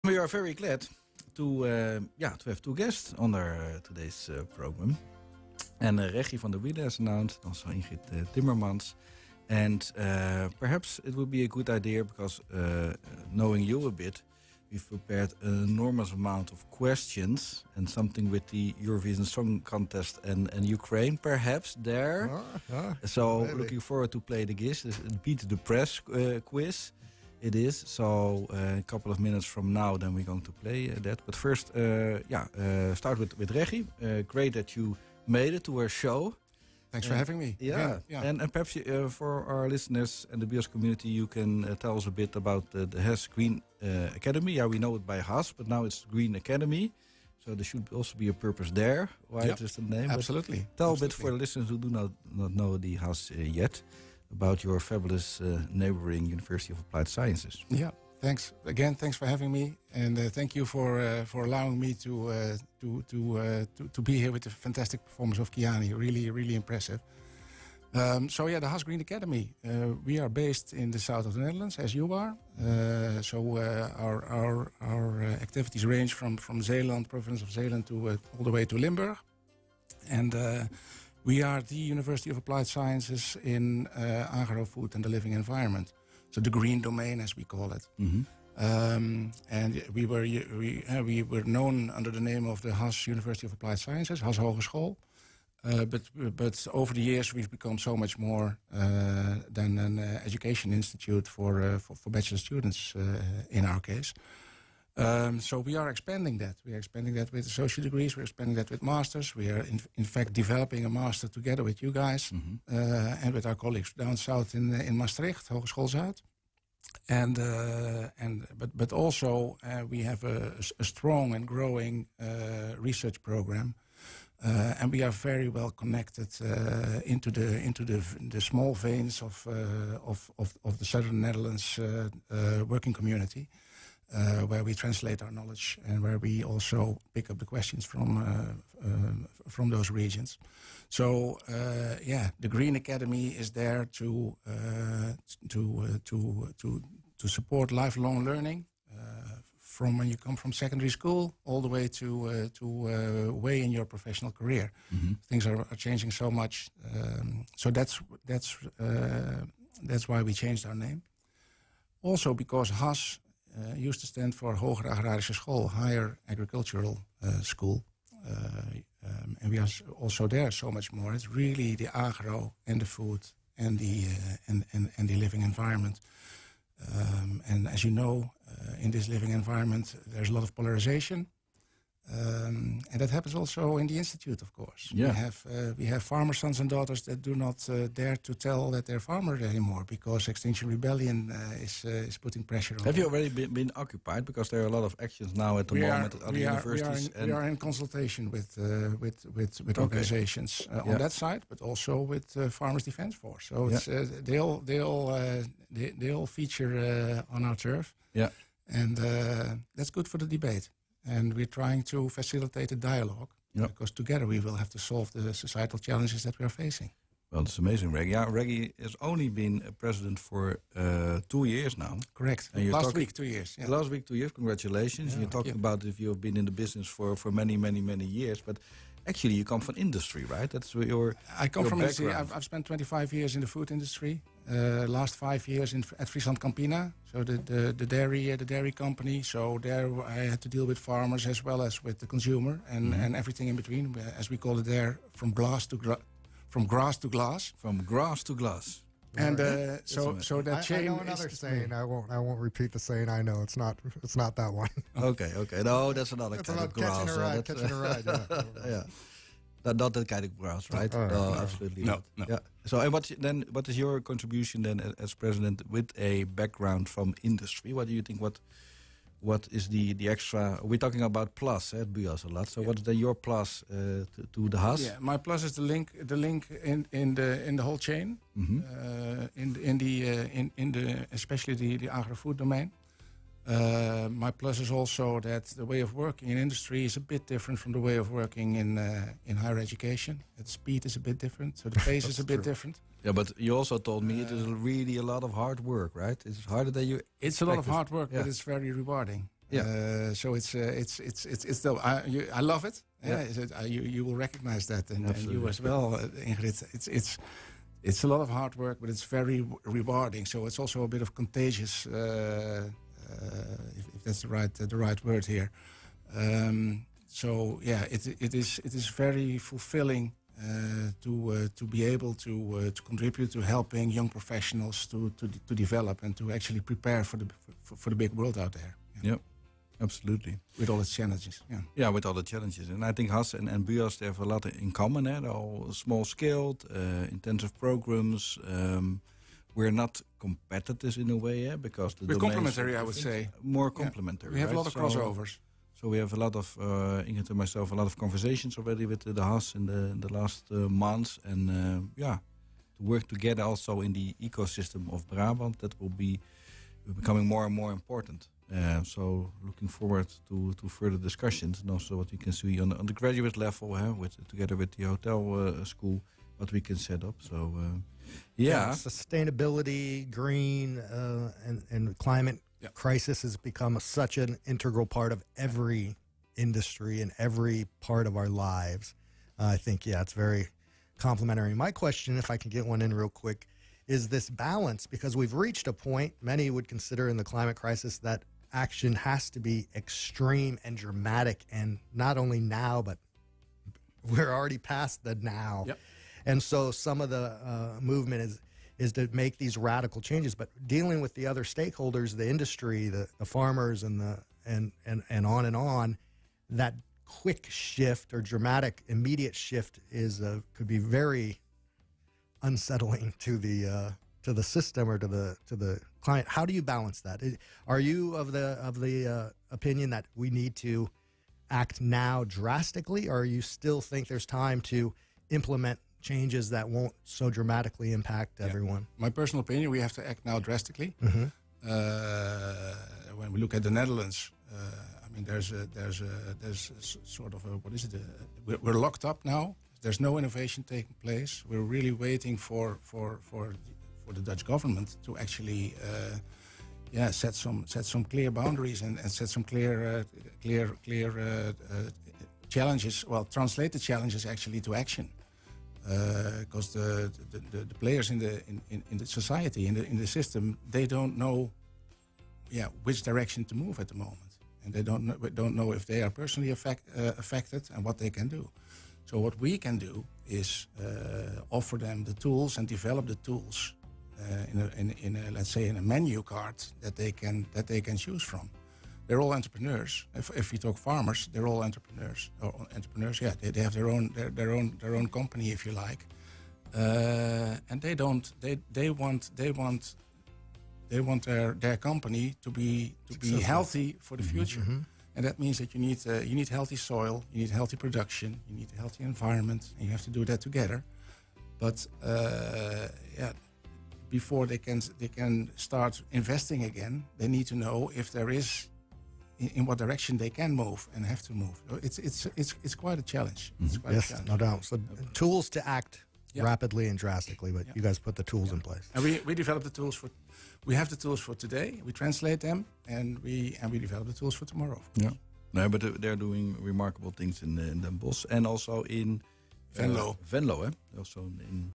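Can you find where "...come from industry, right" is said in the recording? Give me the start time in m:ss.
3:49.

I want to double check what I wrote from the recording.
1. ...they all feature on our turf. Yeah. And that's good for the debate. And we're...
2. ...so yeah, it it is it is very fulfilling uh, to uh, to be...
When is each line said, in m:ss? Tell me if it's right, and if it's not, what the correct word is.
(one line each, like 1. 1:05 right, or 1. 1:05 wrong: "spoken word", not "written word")
1. 3:25 right
2. 5:17 right.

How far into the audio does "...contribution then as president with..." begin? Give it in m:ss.
4:23.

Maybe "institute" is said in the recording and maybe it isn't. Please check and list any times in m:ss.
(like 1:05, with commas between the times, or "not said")
1:40, 3:03.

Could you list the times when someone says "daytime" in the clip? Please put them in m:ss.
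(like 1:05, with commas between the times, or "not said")
not said.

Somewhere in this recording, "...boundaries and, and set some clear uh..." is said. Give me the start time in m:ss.
7:28.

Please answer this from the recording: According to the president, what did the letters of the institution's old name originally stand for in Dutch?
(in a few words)
Hoger Agrarische School.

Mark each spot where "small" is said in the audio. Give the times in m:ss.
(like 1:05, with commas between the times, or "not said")
2:08, 5:35.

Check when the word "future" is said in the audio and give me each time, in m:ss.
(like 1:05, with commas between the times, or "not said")
8:14.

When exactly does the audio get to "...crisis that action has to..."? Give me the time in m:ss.
6:27.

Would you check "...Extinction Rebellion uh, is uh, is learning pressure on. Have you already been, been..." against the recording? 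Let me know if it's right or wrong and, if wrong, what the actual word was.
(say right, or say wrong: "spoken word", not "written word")
wrong: "putting", not "learning".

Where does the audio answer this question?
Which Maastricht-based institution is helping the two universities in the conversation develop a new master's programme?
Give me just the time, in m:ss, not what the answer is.
1:55.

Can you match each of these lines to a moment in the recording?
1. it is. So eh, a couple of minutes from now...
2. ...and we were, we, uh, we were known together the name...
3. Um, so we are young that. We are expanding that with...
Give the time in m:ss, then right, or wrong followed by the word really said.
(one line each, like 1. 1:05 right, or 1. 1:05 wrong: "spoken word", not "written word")
1. 0:27 right
2. 1:29 wrong: "under", not "together"
3. 1:44 wrong: "expanding", not "young".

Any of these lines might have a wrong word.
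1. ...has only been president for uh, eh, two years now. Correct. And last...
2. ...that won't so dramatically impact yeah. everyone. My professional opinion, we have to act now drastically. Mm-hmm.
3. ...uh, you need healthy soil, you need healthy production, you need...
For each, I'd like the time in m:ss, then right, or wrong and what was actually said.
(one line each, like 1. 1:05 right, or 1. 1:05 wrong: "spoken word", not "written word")
1. 3:38 right
2. 7:06 wrong: "personal", not "professional"
3. 8:16 right.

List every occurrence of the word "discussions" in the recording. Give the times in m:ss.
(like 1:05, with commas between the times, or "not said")
6:00.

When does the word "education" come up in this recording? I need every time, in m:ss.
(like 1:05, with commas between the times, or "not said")
1:40, 4:49.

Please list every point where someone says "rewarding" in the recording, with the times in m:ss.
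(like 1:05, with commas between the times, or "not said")
4:58, 5:09.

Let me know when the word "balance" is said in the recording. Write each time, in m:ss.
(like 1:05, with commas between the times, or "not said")
6:24, 6:56.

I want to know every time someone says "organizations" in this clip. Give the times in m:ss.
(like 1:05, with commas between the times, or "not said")
3:19.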